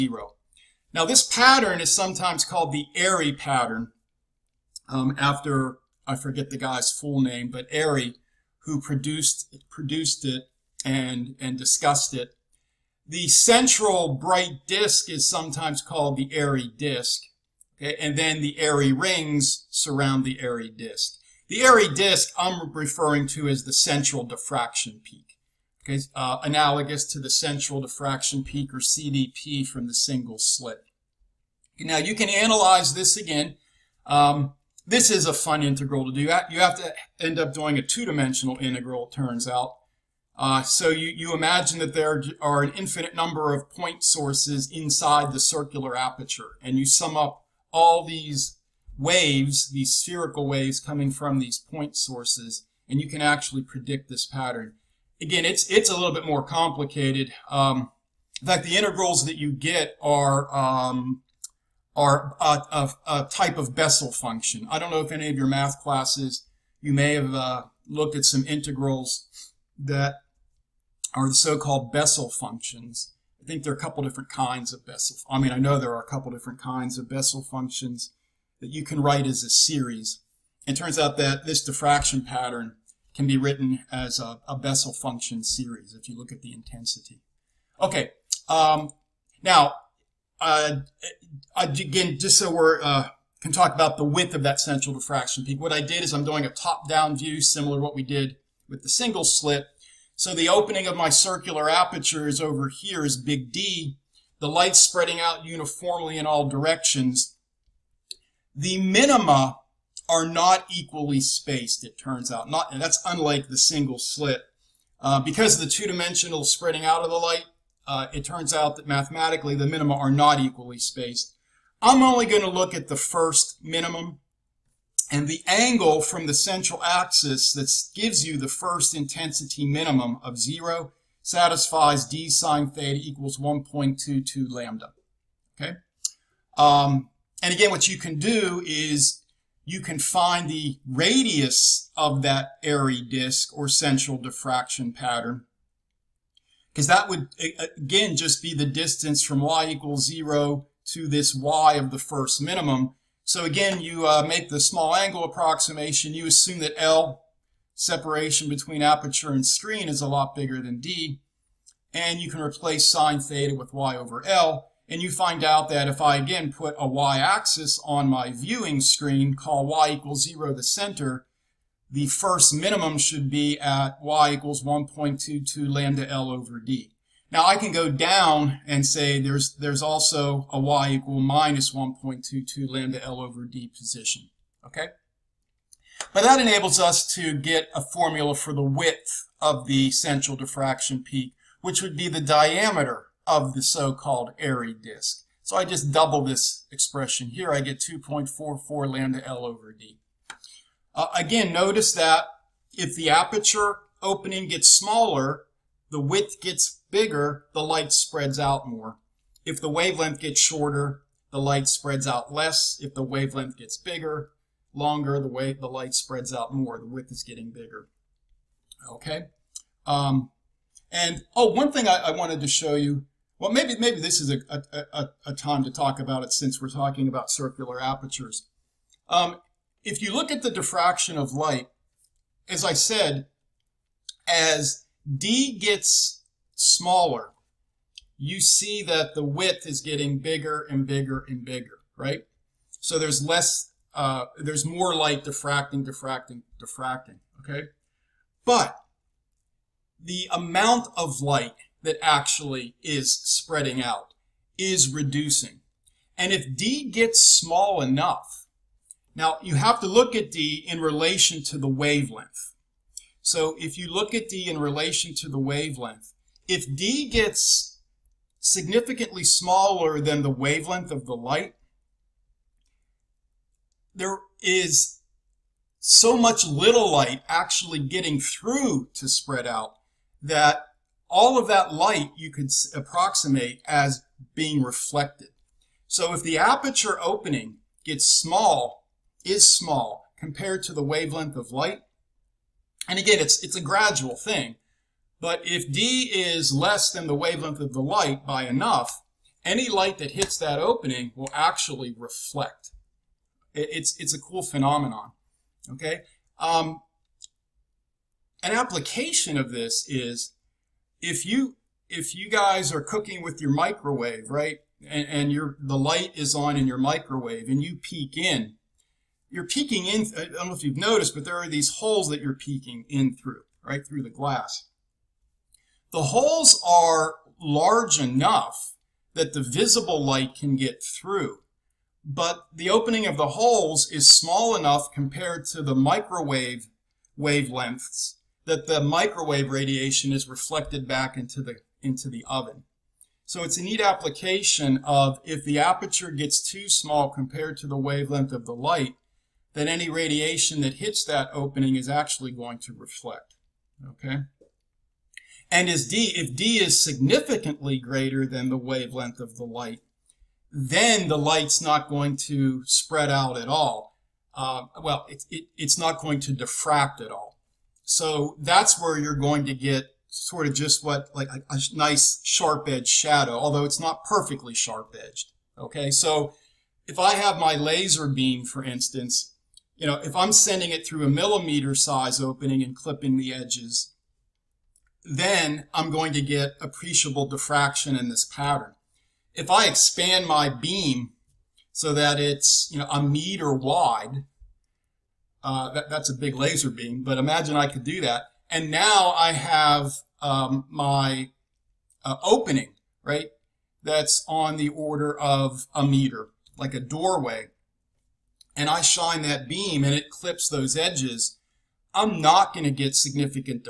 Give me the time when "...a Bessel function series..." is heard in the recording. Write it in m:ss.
1:24.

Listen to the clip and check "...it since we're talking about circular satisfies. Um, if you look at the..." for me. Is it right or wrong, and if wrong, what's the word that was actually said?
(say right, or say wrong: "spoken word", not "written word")
wrong: "apertures", not "satisfies".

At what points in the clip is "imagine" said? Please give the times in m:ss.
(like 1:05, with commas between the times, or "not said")
0:41, 6:37.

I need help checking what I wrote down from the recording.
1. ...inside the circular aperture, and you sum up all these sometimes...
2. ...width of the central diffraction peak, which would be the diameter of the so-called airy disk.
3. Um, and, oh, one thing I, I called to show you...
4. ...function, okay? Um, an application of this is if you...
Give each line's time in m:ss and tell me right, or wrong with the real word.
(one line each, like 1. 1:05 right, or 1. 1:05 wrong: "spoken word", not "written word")
1. 0:44 wrong: "waves", not "sometimes"
2. 3:08 right
3. 3:39 wrong: "wanted", not "called"
4. 5:04 wrong: "phenomenon", not "function".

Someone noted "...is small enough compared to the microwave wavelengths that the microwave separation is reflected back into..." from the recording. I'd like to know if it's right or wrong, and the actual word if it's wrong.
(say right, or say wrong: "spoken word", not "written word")
wrong: "radiation", not "separation".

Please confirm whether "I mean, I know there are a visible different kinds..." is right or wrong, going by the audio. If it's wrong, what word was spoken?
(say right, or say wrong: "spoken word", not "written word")
wrong: "couple", not "visible".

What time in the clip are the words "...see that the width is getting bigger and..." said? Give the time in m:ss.
3:58.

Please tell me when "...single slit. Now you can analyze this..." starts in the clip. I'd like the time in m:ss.
0:29.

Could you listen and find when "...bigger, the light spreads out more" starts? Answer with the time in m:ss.
3:26.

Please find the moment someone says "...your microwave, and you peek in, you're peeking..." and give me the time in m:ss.
5:16.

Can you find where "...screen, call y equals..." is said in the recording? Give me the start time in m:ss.
2:48.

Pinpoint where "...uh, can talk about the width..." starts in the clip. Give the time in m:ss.
1:32.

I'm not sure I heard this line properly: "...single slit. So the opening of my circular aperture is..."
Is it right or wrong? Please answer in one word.
right.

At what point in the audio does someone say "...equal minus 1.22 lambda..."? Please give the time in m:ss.
3:00.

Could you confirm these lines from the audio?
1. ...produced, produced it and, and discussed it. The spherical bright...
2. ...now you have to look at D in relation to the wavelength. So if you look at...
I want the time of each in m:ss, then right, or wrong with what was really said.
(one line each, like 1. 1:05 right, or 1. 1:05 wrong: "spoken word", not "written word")
1. 0:08 wrong: "central", not "spherical"
2. 4:19 right.